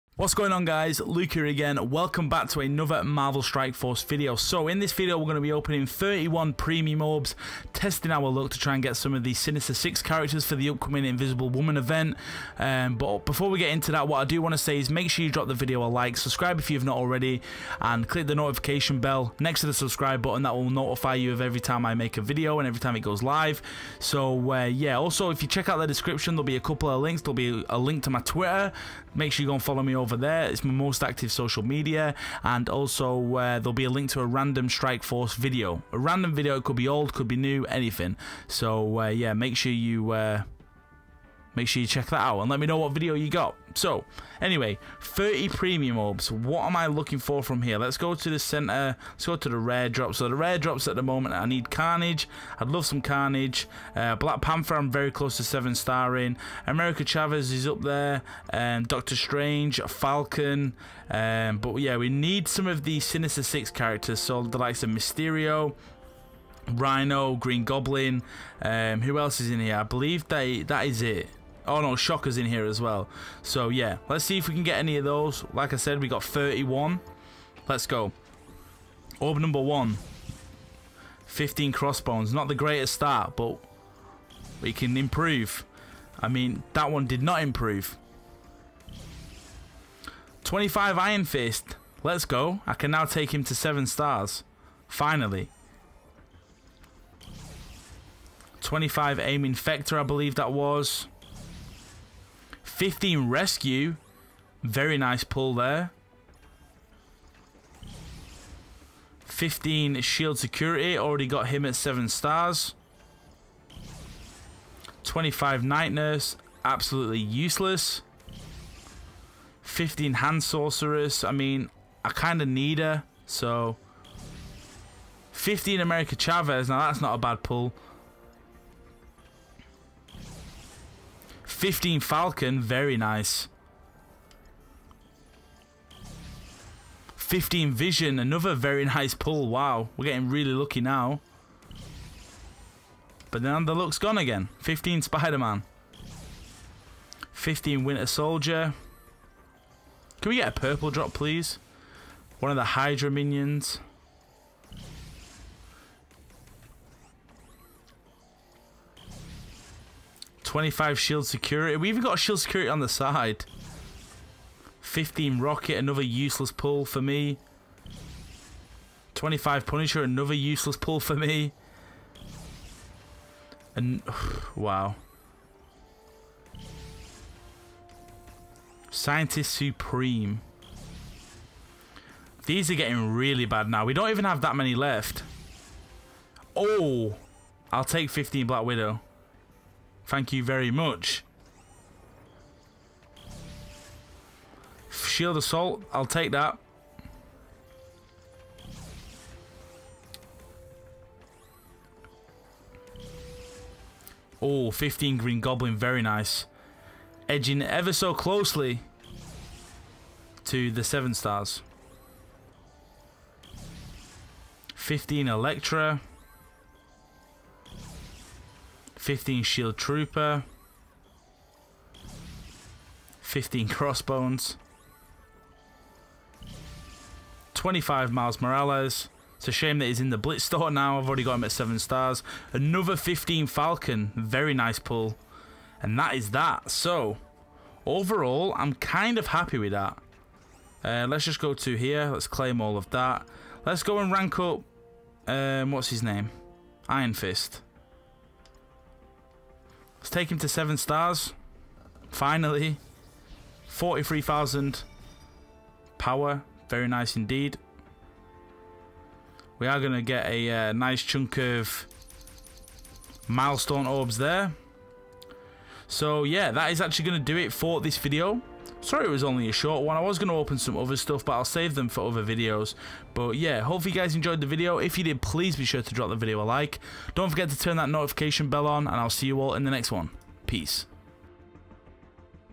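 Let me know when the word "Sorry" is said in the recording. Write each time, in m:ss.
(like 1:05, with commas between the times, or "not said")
4:28.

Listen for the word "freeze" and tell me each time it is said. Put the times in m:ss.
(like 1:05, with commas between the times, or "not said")
not said.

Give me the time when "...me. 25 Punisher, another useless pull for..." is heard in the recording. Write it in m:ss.
2:47.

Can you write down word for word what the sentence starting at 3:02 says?
These are getting really bad now.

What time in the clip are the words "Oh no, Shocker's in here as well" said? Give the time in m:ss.
1:11.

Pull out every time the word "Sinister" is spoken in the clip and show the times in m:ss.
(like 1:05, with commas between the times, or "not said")
0:09, 1:02.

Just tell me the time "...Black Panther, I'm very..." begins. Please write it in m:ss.
0:54.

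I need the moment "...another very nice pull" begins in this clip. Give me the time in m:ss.
2:18.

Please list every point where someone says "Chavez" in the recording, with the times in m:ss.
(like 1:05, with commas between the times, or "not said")
0:57, 2:06.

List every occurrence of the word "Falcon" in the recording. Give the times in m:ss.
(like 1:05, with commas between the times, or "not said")
0:59, 2:11, 3:53.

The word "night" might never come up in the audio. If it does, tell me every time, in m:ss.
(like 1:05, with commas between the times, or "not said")
1:55.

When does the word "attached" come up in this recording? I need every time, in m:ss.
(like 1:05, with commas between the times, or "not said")
not said.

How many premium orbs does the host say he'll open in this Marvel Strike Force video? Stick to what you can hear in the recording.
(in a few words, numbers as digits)
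31.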